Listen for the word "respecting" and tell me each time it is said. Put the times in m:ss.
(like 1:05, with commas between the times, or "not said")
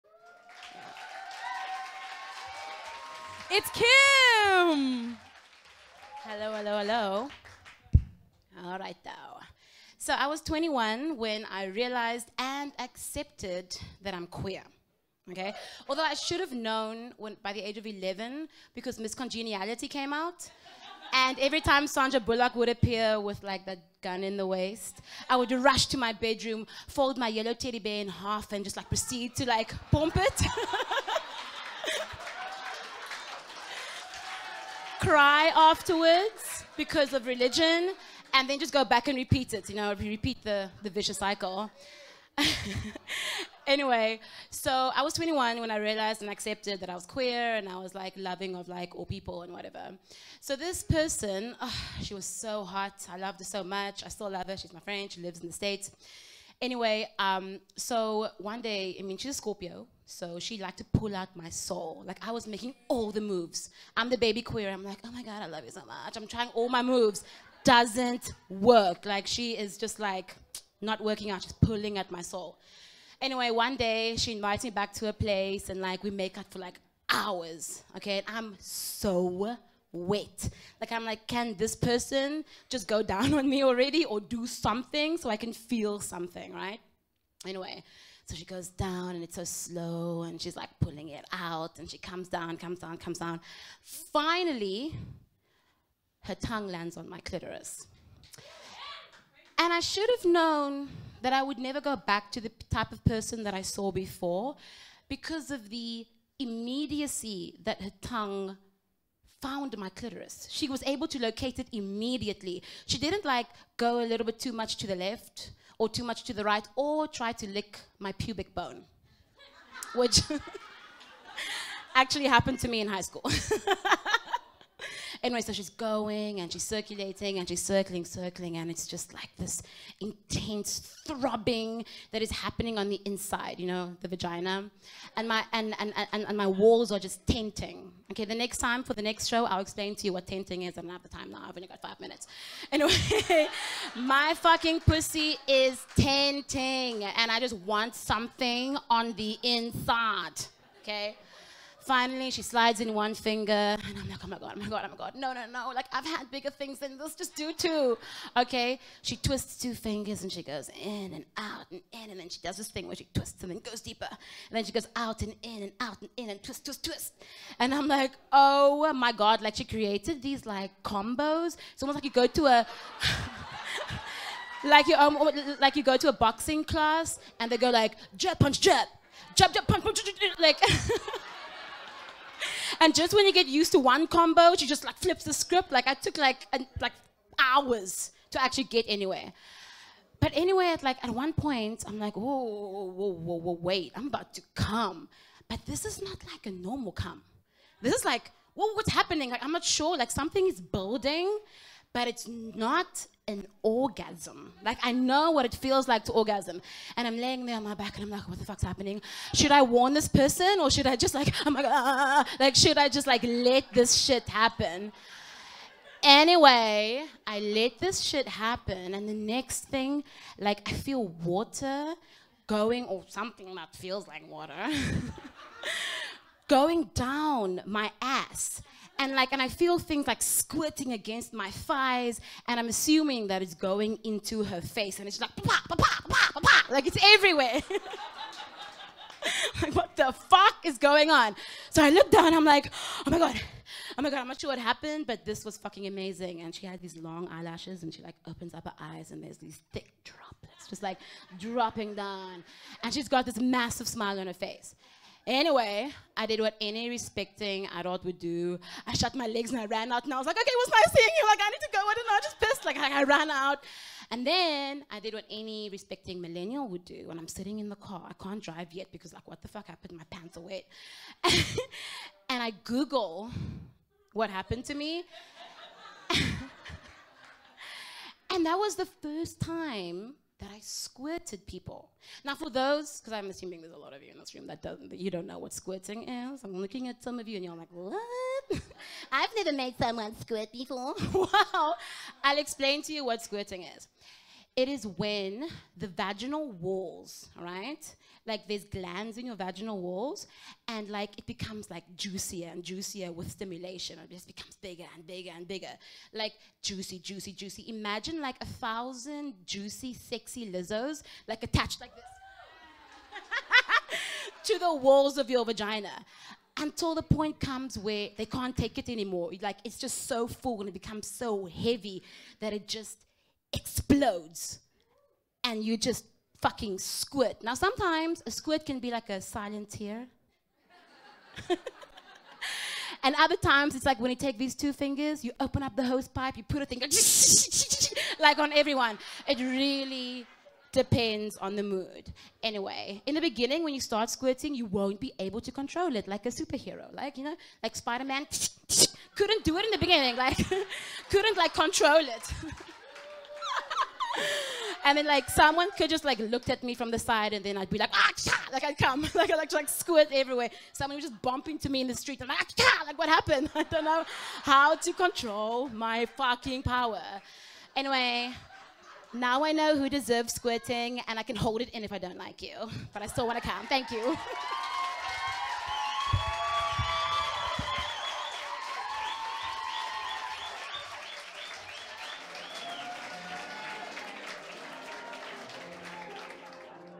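4:16, 4:25.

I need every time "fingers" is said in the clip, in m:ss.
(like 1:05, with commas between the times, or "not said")
2:33, 2:39, 5:34.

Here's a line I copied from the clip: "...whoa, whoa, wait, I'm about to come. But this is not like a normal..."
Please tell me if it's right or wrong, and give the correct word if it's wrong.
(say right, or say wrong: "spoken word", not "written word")
right.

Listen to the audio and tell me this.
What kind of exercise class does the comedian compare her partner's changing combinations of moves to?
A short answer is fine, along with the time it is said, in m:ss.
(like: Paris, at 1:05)
Boxing class, at 2:56.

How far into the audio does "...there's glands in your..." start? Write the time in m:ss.
4:58.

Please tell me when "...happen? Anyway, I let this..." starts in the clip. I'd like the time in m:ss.
3:34.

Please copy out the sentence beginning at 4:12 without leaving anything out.
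And she's got this massive smile on her face.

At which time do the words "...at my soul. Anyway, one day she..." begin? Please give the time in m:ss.
1:11.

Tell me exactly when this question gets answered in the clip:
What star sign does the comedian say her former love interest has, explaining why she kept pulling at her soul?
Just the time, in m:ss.
0:59.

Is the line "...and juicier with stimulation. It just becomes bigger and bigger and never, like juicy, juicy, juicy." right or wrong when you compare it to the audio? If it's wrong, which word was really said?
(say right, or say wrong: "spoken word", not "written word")
wrong: "bigger", not "never".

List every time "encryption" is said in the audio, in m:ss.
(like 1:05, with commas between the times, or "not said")
not said.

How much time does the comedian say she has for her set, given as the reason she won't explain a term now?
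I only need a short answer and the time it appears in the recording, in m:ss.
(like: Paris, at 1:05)
5 minutes, at 2:21.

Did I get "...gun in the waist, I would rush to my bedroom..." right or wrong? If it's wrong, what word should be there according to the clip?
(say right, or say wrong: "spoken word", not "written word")
right.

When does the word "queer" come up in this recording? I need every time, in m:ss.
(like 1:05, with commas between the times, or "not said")
0:14, 0:47, 1:04.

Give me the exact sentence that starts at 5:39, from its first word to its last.
It really depends on the mood.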